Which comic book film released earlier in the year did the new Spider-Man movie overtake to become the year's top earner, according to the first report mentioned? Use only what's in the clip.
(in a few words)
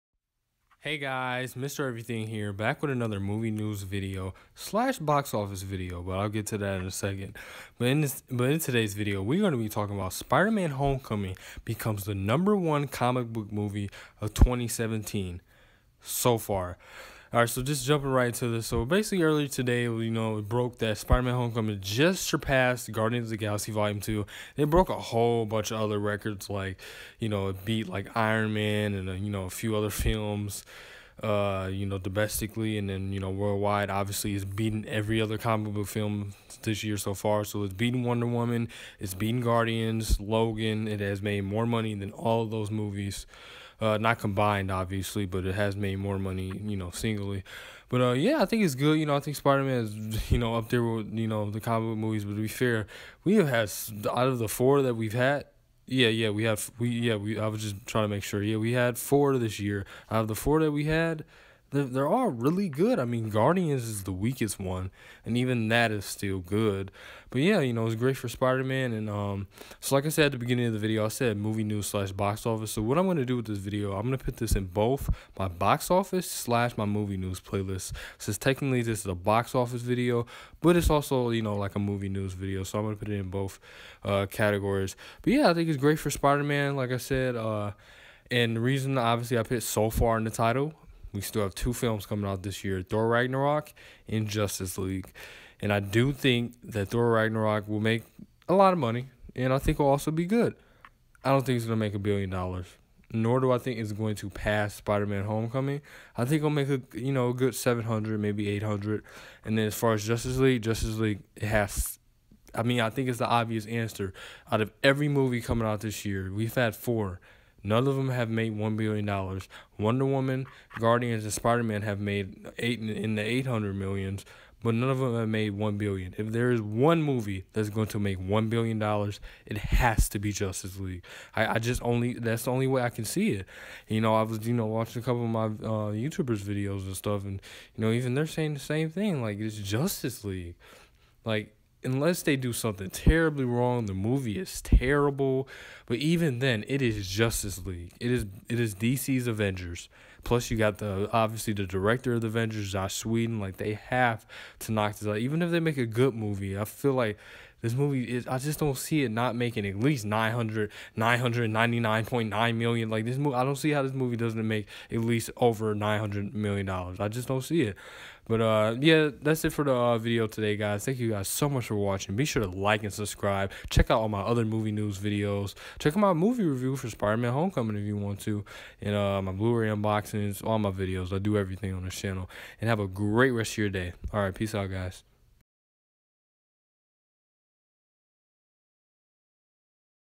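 Guardians of the Galaxy Volume Two.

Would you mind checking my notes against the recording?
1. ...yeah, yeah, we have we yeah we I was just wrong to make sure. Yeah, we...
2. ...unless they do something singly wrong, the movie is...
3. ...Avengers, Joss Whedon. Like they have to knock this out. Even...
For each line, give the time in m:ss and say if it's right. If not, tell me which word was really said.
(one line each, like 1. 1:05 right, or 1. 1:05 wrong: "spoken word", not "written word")
1. 0:55 wrong: "trying", not "wrong"
2. 2:21 wrong: "terribly", not "singly"
3. 2:32 right.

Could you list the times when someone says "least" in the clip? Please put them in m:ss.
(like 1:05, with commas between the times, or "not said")
2:39, 2:44.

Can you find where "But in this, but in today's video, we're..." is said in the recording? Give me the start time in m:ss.
0:07.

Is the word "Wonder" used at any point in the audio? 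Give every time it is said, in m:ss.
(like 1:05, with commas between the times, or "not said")
0:38, 1:59.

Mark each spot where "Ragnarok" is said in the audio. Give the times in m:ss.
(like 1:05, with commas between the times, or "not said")
1:33, 1:37.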